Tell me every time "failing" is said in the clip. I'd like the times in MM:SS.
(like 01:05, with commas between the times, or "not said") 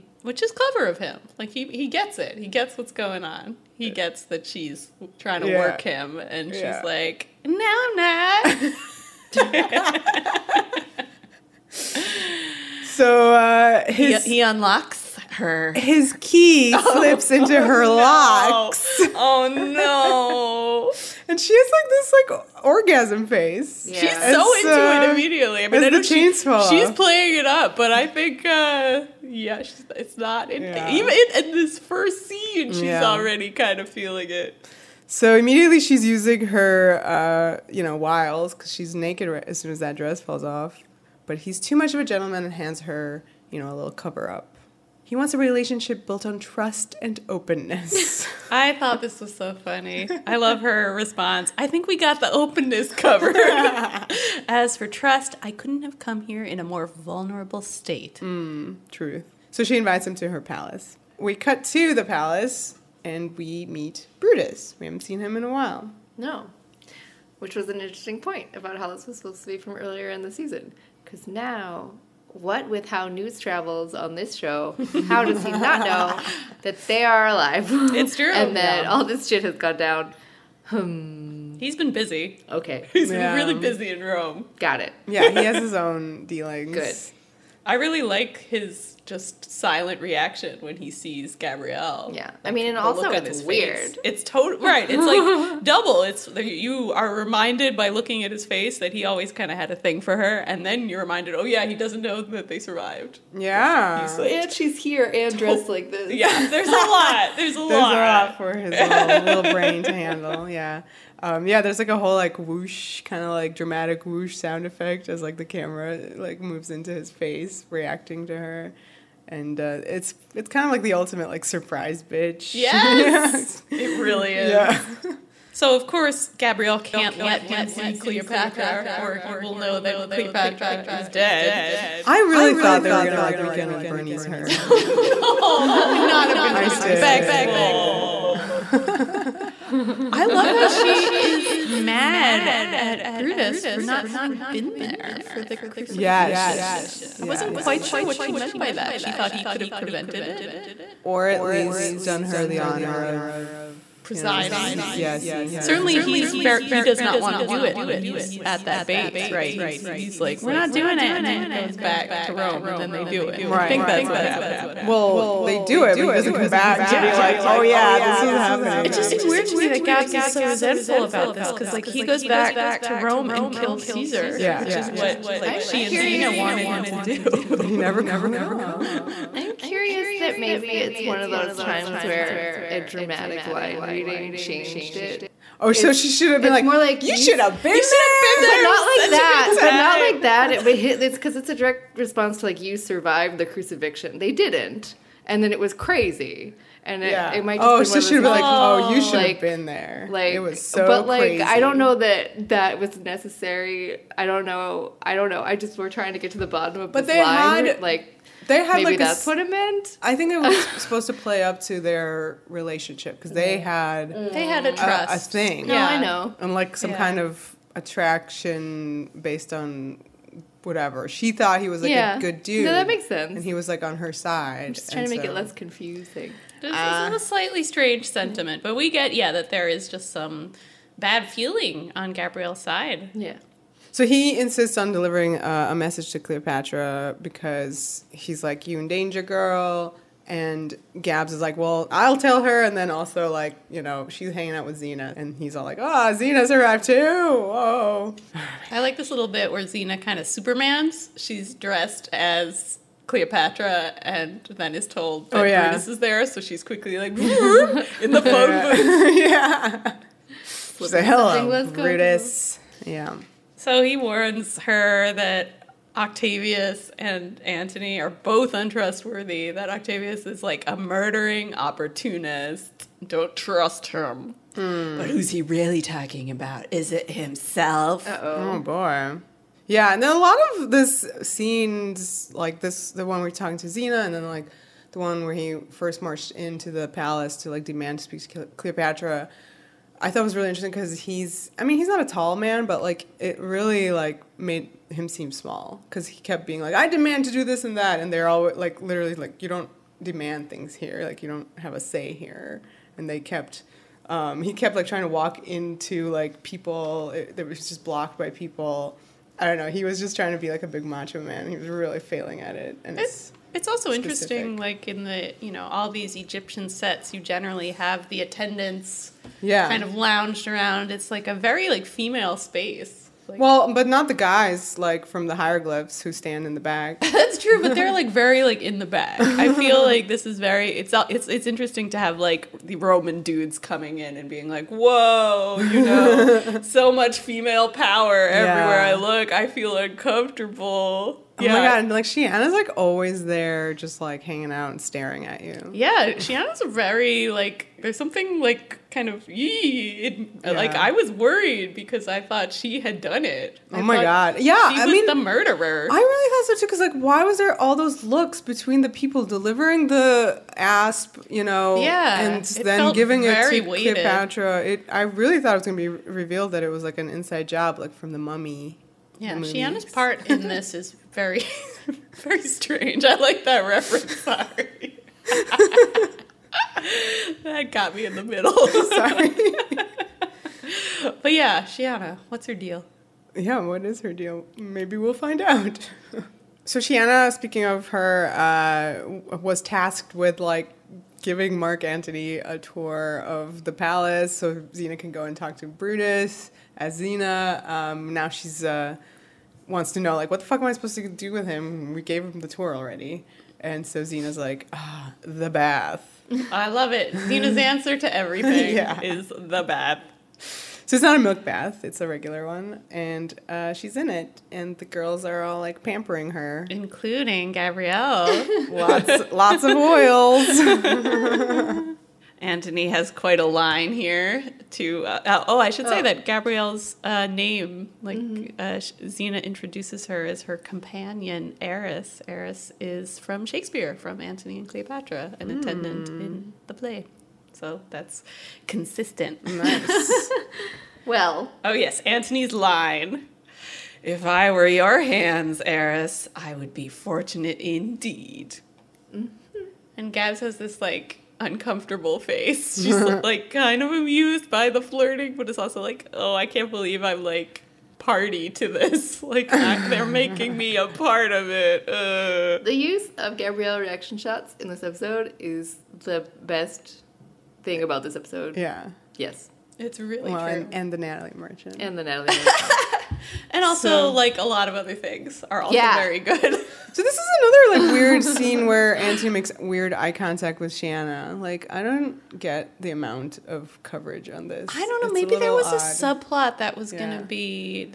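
05:11.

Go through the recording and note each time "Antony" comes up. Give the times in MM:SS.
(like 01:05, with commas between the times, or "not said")
04:27, 06:31, 07:02, 07:14, 07:21, 07:58.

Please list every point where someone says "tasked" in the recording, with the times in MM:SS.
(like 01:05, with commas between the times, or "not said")
06:29.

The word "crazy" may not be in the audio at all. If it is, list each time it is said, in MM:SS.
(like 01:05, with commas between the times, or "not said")
03:15, 03:21.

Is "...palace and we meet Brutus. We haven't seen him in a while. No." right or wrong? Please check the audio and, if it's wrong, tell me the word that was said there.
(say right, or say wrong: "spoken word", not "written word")
right.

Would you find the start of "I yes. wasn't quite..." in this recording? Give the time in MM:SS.
02:27.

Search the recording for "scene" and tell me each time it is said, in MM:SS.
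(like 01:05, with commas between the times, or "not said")
00:32, 04:41, 07:58.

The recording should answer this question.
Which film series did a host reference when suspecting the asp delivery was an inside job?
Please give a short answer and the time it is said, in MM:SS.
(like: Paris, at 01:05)
The Mummy, at 06:08.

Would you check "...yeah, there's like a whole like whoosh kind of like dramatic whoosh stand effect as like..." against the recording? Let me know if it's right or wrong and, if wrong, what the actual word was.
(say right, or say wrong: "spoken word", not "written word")
wrong: "sound", not "stand".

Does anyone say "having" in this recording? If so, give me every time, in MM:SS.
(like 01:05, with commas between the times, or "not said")
02:24.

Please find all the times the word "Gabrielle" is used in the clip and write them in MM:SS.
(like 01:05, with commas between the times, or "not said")
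01:31, 02:06, 03:52, 06:57, 07:06, 07:43.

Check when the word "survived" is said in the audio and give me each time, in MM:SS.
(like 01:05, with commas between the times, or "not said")
01:42, 03:12.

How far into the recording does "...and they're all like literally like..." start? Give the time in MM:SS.
04:57.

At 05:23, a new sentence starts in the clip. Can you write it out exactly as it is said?
Like, well, but not the guys like from the hieroglyphs who stand in the back.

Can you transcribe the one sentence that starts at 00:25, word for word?
I mean, she's playing it up, but I think uh yeah, it's not in, yeah.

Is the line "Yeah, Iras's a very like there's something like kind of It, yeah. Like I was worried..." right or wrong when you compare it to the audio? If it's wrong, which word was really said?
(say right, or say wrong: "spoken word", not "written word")
wrong: "Shiana", not "Iras".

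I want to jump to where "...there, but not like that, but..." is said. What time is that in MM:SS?
03:08.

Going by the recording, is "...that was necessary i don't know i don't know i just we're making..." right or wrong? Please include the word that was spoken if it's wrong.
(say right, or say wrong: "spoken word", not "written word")
wrong: "trying", not "making".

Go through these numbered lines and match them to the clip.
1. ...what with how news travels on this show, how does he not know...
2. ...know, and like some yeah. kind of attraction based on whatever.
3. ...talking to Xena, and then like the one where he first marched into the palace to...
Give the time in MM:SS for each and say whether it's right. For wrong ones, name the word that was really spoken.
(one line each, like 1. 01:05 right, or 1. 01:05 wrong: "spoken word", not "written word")
1. 01:12 right
2. 03:35 right
3. 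04:43 right.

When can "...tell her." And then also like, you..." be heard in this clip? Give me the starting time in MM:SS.
04:02.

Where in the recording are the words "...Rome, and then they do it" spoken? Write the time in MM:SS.
02:42.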